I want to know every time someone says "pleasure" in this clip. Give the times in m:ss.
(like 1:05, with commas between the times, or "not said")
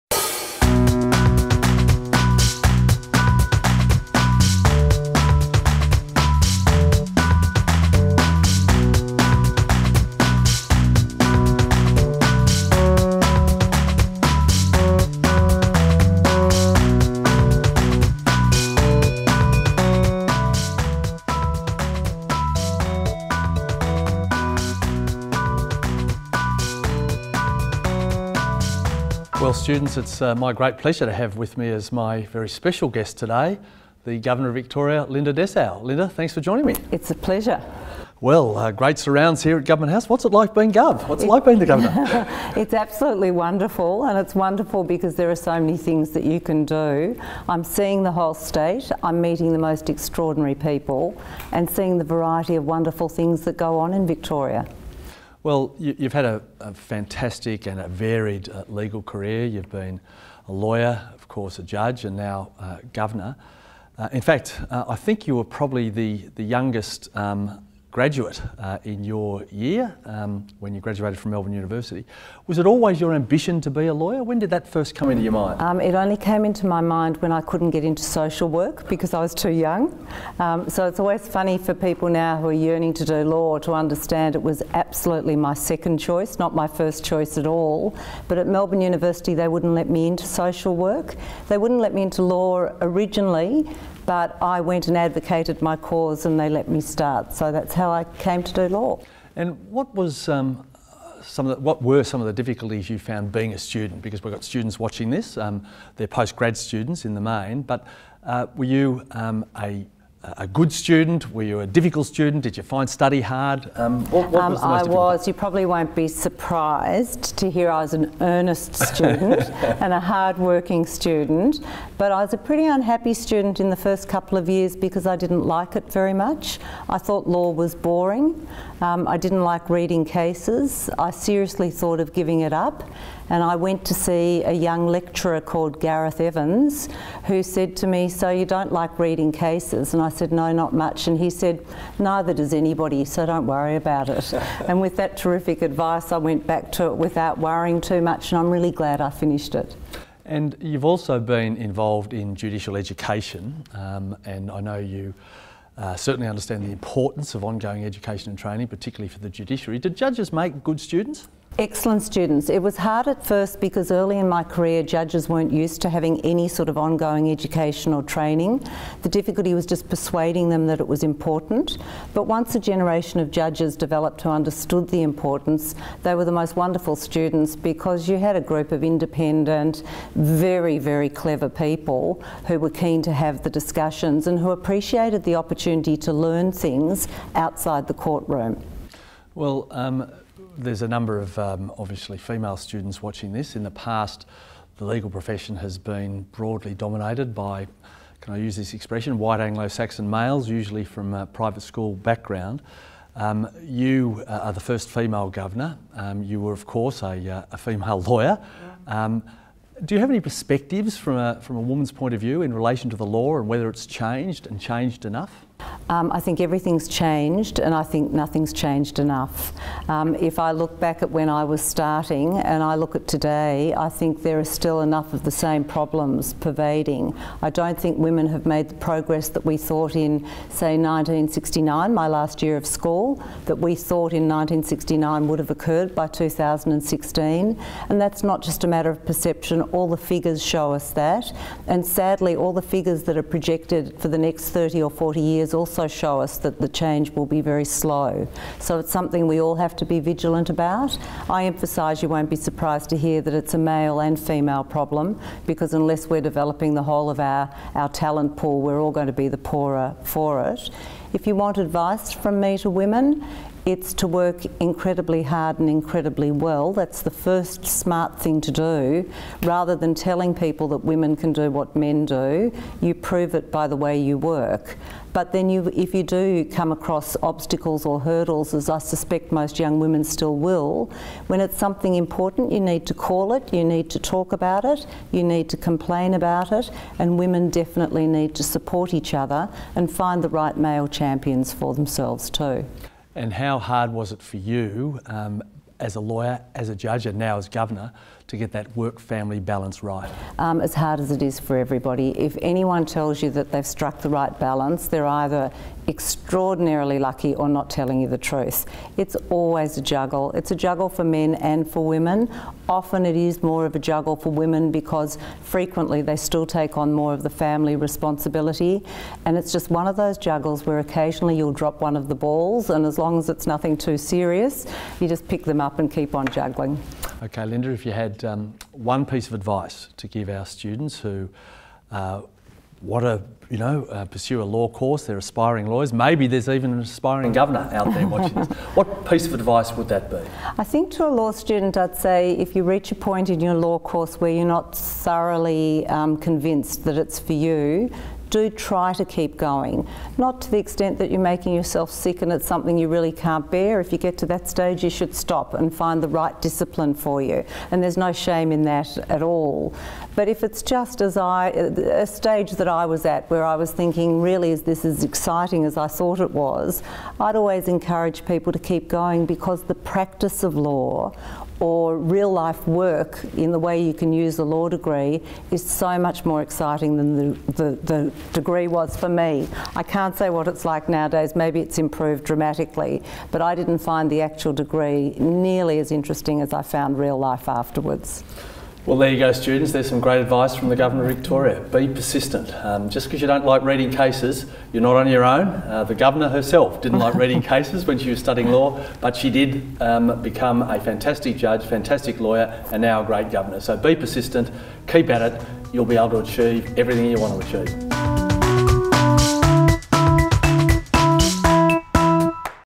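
0:30, 0:37.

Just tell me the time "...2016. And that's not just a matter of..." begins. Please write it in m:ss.
3:56.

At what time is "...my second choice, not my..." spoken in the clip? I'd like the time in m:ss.
1:25.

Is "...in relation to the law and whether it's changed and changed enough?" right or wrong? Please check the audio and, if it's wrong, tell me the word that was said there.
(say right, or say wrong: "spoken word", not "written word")
right.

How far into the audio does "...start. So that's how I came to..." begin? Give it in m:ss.
1:36.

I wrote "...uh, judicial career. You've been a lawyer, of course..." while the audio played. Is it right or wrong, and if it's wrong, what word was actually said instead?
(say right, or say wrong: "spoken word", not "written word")
wrong: "legal", not "judicial".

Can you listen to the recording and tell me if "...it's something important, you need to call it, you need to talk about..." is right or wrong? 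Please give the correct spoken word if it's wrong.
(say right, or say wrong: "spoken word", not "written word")
right.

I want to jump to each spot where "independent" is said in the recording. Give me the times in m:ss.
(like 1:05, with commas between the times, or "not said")
2:58.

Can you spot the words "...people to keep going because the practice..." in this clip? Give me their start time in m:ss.
6:08.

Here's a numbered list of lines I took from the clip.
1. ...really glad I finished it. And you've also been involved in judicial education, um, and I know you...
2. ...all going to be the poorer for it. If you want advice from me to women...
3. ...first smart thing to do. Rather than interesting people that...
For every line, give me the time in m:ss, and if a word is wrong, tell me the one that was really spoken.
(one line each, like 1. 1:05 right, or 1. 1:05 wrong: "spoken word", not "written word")
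1. 2:28 right
2. 4:18 right
3. 4:27 wrong: "telling", not "interesting".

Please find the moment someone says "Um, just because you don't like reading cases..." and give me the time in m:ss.
6:32.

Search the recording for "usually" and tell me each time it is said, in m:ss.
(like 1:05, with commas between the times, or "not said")
3:20.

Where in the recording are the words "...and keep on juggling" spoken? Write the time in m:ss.
5:25.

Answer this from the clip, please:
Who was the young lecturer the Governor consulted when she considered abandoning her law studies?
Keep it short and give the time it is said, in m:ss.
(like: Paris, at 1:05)
Gareth Evans, at 2:15.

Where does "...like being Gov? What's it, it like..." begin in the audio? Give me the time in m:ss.
0:40.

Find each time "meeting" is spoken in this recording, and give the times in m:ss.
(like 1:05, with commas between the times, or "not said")
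0:49.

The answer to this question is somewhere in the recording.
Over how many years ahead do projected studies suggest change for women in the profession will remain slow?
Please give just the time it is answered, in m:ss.
4:04.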